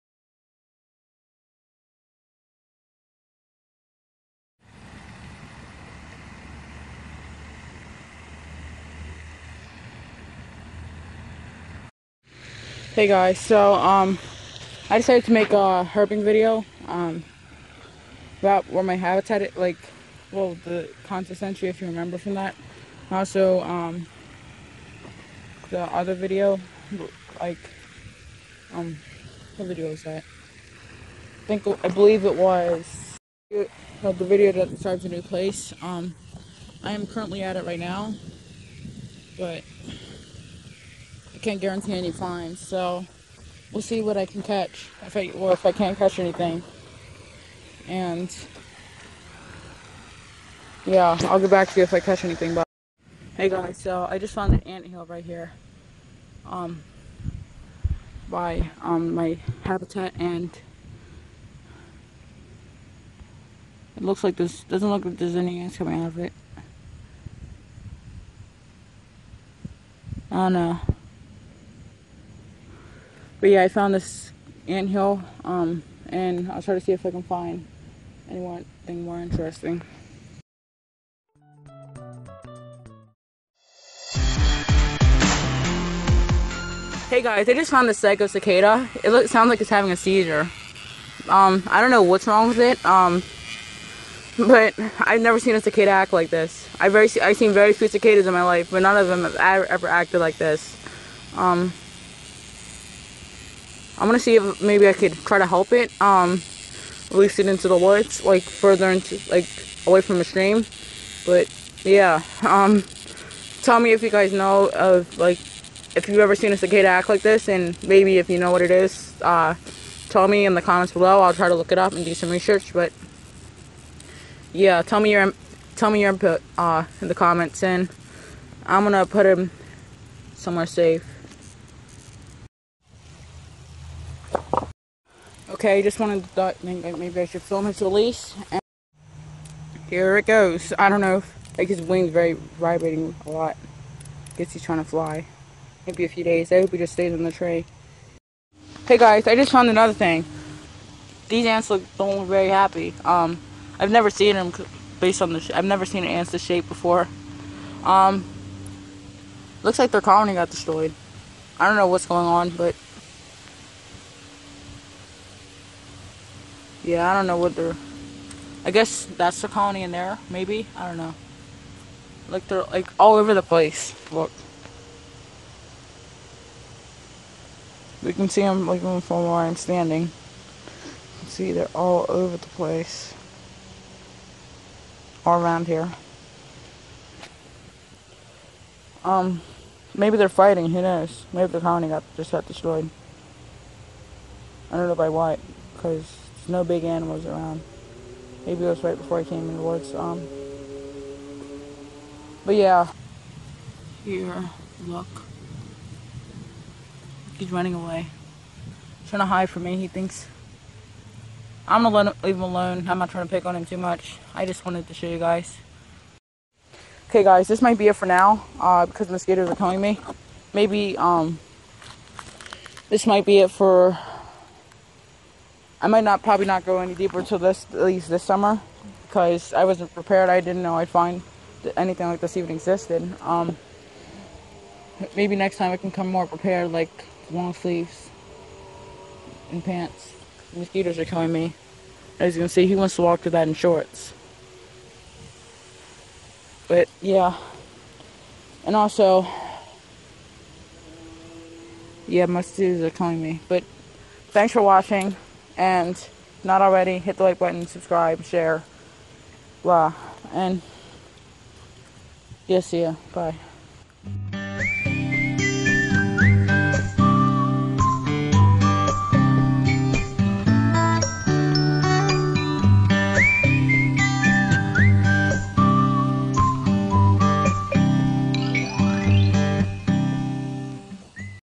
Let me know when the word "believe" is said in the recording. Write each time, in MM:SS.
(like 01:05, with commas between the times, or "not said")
00:31.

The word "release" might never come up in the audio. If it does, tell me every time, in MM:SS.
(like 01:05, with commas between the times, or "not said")
01:47, 02:17.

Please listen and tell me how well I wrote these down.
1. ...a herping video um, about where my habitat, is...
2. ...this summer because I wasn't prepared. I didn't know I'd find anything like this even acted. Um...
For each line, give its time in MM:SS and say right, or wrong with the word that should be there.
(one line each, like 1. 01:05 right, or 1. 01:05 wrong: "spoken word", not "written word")
1. 00:15 right
2. 03:48 wrong: "existed", not "acted".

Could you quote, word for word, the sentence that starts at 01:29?
It looks, sounds like it's having a seizure.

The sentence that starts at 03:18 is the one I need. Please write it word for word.
Maybe it was right before I came in the woods.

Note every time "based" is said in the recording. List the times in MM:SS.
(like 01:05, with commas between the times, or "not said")
02:34.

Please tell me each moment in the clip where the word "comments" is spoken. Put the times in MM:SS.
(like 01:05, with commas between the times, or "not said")
02:00, 02:07.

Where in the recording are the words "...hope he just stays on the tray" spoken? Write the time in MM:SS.
02:26.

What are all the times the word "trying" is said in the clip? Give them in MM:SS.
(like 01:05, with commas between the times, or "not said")
02:24, 03:29, 03:33.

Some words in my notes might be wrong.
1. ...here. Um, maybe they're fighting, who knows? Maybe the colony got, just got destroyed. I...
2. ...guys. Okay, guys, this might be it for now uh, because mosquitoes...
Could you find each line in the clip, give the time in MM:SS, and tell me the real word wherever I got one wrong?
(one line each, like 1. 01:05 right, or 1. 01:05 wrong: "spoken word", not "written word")
1. 03:05 right
2. 03:35 right.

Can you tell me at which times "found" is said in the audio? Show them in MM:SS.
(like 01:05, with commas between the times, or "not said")
00:54, 01:13, 01:27, 02:29.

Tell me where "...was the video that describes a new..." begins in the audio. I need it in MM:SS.
00:32.